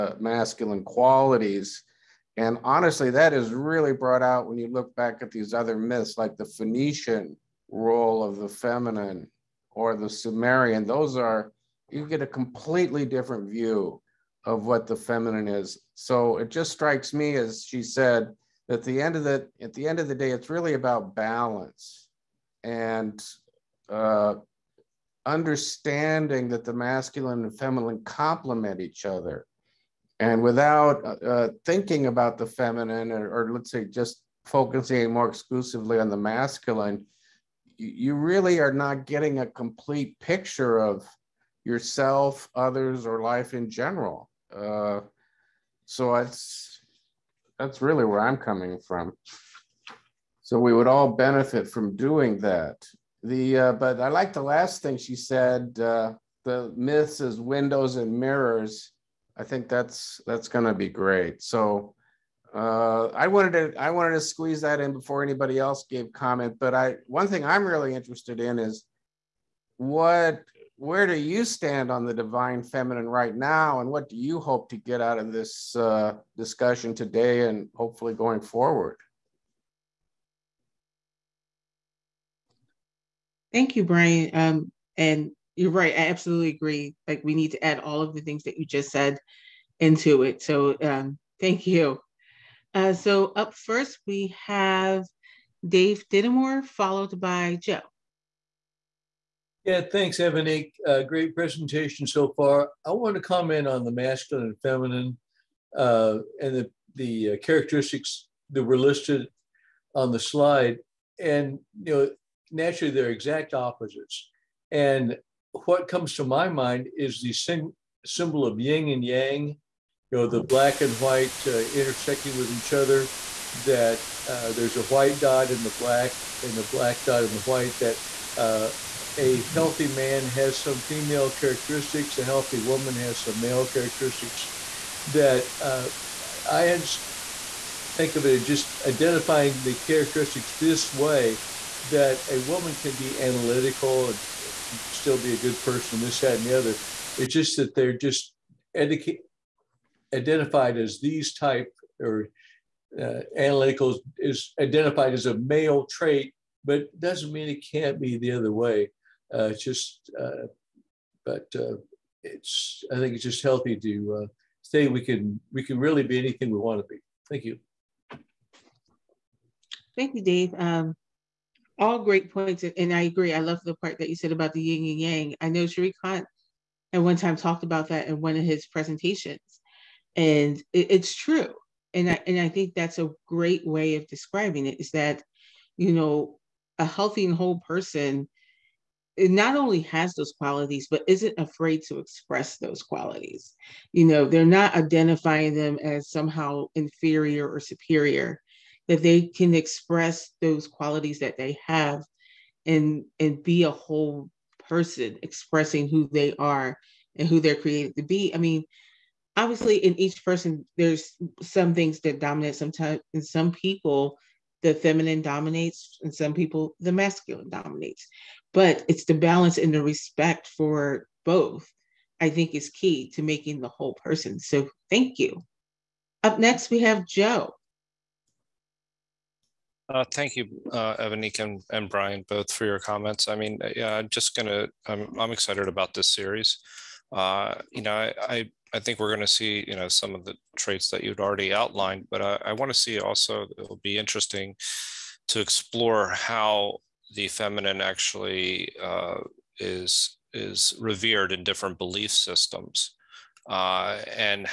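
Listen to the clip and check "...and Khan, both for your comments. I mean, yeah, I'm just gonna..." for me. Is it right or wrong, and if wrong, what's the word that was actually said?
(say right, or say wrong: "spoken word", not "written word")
wrong: "Brian", not "Khan".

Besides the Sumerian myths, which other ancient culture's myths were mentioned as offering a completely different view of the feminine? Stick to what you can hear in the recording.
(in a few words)
Phoenician.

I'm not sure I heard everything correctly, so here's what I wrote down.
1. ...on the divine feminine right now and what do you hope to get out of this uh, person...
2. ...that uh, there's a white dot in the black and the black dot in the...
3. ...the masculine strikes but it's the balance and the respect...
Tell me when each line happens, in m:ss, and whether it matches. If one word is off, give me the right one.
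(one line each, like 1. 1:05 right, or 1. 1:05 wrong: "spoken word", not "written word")
1. 1:11 wrong: "discussion", not "person"
2. 2:03 right
3. 3:36 wrong: "dominates", not "strikes".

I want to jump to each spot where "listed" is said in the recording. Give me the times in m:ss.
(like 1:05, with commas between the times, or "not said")
1:48.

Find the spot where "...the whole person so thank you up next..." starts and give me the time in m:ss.
3:43.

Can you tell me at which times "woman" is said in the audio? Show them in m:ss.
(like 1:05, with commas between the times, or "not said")
2:12, 2:22.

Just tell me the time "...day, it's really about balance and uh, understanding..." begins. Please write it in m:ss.
0:20.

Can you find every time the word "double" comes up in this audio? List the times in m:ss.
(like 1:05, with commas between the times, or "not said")
not said.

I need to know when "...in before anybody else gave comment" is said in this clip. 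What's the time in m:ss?
1:04.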